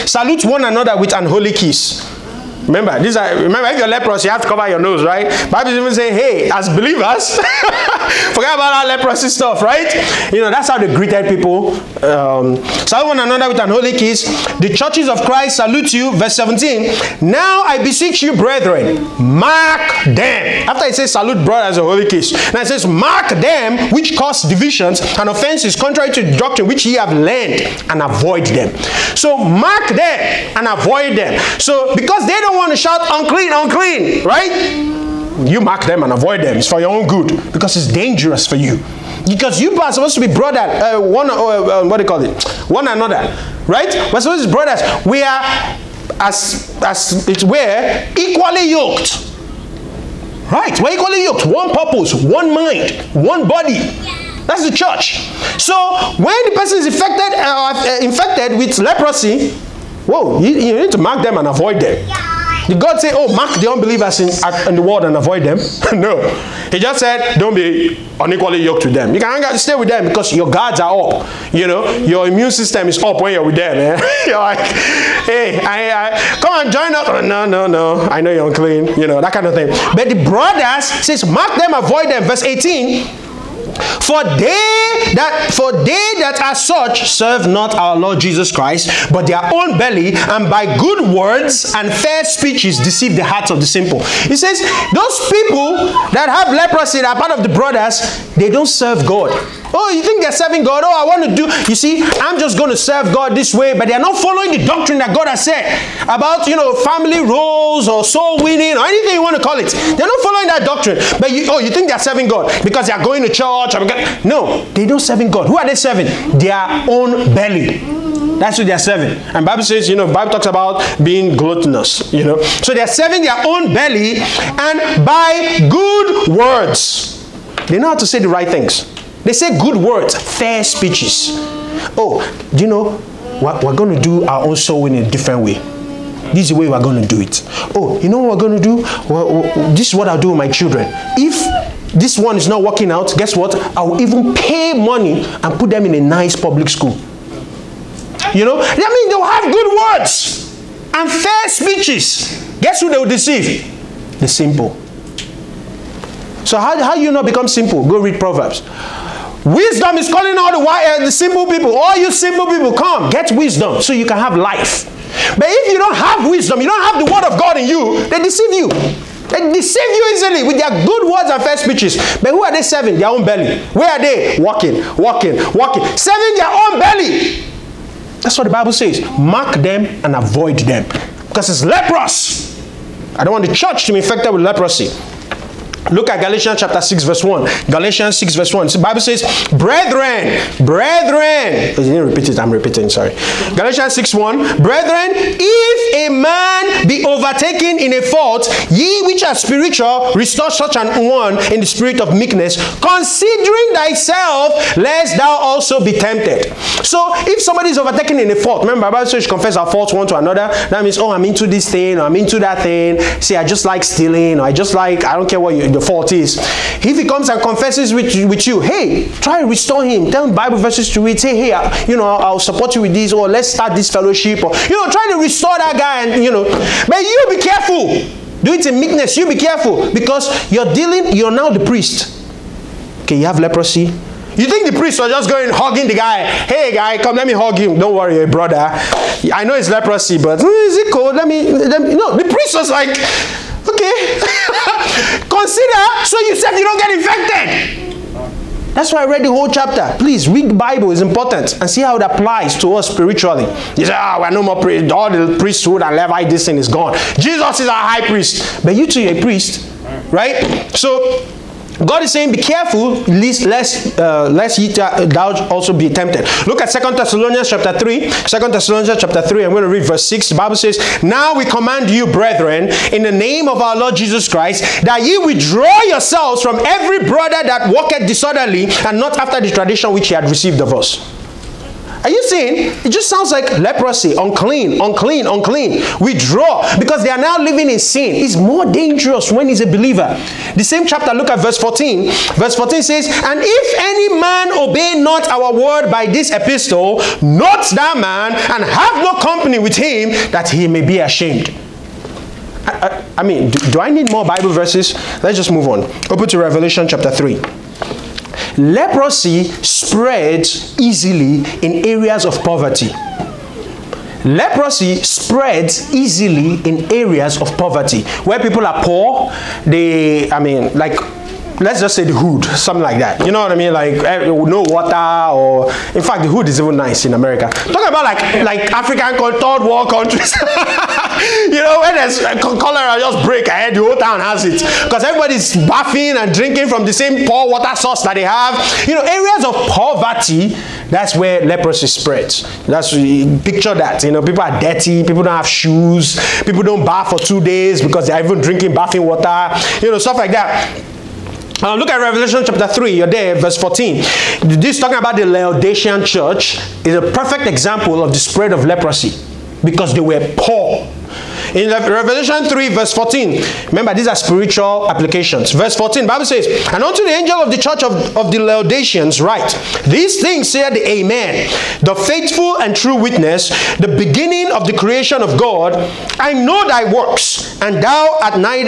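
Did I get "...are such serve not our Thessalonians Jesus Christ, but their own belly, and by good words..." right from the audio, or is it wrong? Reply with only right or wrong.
wrong.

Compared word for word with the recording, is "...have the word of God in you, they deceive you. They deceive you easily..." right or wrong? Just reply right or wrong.
right.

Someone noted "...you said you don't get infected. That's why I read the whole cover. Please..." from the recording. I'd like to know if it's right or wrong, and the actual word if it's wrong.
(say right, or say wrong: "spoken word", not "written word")
wrong: "chapter", not "cover".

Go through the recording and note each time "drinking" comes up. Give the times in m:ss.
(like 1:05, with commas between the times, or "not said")
5:36, 5:48.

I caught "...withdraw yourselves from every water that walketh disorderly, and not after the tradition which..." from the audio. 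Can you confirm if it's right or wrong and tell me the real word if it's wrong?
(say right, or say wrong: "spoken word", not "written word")
wrong: "brother", not "water".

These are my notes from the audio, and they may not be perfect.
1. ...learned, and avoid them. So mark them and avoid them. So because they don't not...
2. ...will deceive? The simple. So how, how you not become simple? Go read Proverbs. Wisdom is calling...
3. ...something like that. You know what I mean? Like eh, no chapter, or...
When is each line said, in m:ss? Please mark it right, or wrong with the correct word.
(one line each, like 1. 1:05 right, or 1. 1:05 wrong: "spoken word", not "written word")
1. 0:27 right
2. 2:32 right
3. 5:22 wrong: "water", not "chapter".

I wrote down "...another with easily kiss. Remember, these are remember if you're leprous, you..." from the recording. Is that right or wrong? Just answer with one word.
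wrong.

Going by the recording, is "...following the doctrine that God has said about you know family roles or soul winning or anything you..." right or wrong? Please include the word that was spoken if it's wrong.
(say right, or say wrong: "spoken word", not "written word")
right.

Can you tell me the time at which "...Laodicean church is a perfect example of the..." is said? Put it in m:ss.
5:55.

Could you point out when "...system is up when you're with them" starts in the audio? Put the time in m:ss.
1:12.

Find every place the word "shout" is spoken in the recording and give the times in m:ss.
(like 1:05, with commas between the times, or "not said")
0:32.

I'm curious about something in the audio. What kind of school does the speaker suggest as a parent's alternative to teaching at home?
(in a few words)
Public school.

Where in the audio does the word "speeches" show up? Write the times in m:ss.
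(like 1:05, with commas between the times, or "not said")
1:32, 2:10, 2:31, 2:51.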